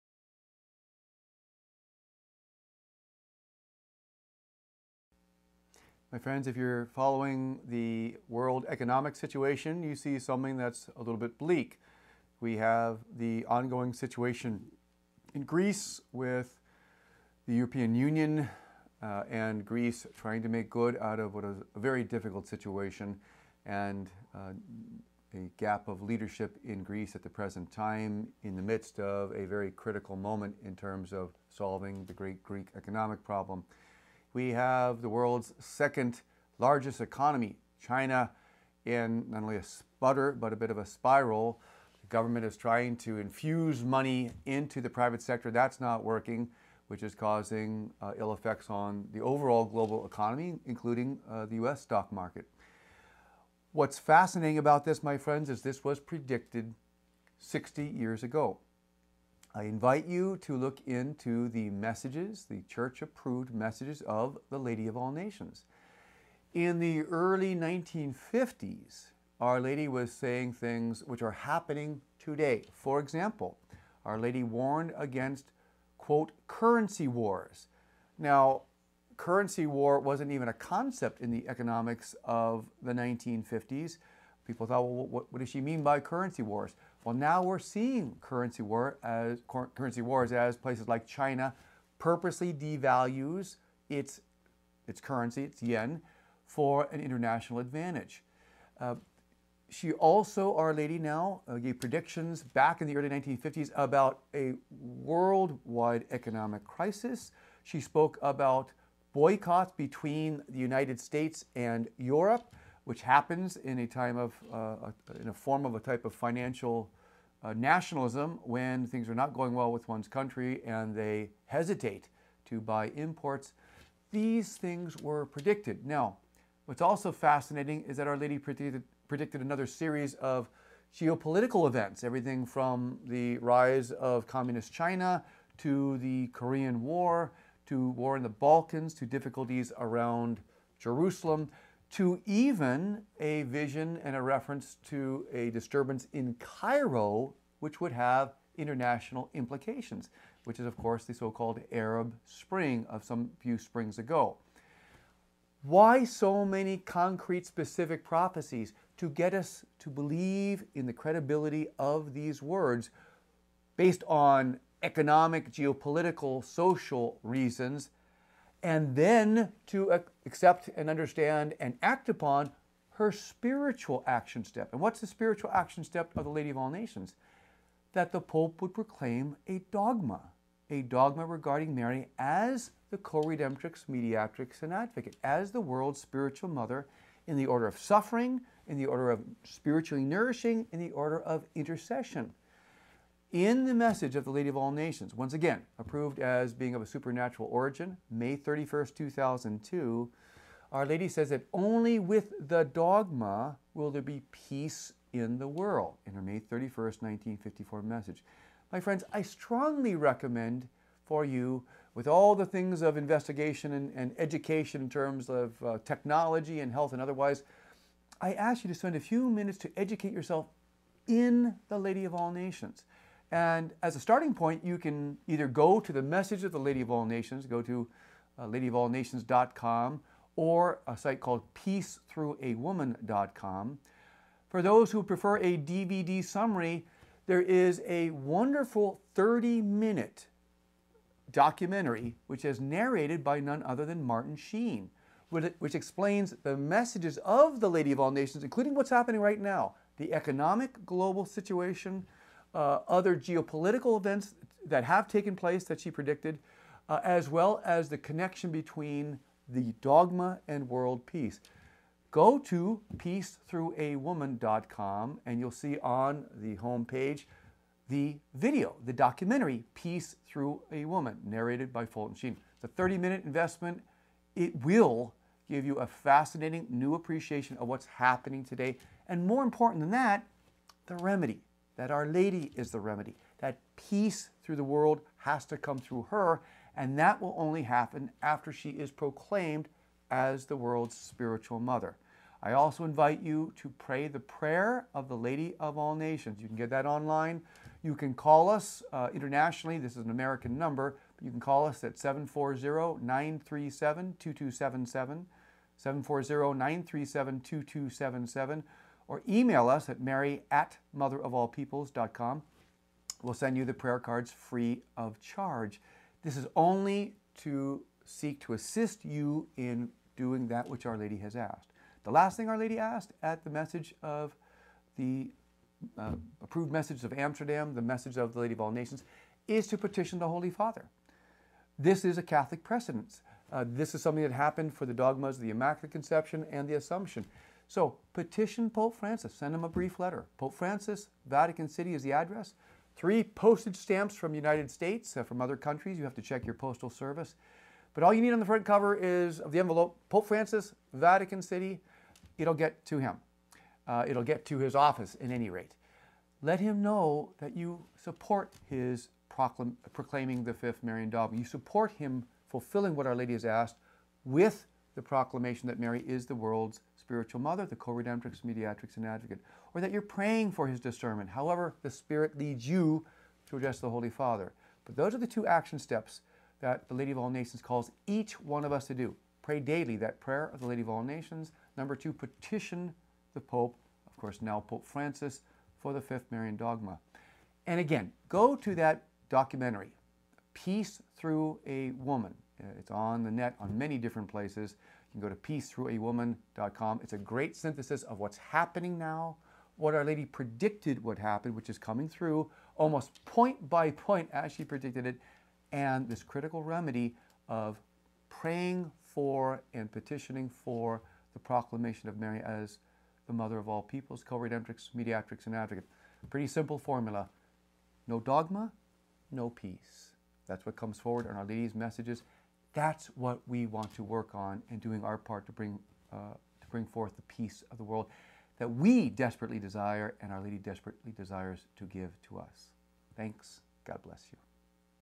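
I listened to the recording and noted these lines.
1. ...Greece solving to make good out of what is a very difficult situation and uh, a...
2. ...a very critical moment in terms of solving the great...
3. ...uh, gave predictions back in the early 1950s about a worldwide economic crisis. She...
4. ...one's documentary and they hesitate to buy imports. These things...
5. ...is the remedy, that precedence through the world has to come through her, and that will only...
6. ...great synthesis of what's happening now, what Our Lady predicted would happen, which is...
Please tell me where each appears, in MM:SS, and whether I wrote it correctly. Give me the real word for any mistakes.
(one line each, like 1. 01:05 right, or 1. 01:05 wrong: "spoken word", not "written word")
1. 00:19 wrong: "trying", not "solving"
2. 00:29 right
3. 01:41 right
4. 01:59 wrong: "country", not "documentary"
5. 04:42 wrong: "peace", not "precedence"
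6. 06:37 right.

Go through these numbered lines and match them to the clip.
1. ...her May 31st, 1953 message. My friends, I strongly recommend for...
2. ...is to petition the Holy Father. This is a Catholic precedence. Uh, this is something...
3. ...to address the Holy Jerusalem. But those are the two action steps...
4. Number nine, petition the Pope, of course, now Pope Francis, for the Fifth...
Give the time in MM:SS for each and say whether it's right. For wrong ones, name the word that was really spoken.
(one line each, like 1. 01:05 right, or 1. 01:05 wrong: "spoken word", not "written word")
1. 03:26 wrong: "1954", not "1953"
2. 05:29 right
3. 06:13 wrong: "Father", not "Jerusalem"
4. 06:21 wrong: "two", not "nine".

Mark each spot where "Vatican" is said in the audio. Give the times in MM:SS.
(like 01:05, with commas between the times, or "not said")
05:41, 05:50.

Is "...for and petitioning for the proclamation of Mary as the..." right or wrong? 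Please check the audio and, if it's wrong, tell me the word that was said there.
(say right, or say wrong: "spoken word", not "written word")
right.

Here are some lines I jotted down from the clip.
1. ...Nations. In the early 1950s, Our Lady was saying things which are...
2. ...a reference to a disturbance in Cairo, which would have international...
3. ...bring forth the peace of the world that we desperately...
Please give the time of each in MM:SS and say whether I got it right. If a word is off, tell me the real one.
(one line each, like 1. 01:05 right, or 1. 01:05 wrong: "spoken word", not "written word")
1. 01:05 right
2. 02:24 right
3. 07:06 right.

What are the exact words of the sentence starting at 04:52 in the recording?
I also invite you to pray the prayer of the Lady of All Nations.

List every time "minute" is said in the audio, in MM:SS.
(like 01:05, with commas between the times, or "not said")
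03:39, 03:59, 04:32.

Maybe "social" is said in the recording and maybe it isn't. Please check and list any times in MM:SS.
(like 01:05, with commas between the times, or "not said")
02:46.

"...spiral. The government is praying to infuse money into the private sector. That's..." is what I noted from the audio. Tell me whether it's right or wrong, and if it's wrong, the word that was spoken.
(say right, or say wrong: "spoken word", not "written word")
wrong: "trying", not "praying".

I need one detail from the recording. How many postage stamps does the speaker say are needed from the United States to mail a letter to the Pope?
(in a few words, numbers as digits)
3.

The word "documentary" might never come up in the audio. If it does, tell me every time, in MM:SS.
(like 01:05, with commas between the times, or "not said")
04:01, 04:28, 06:29.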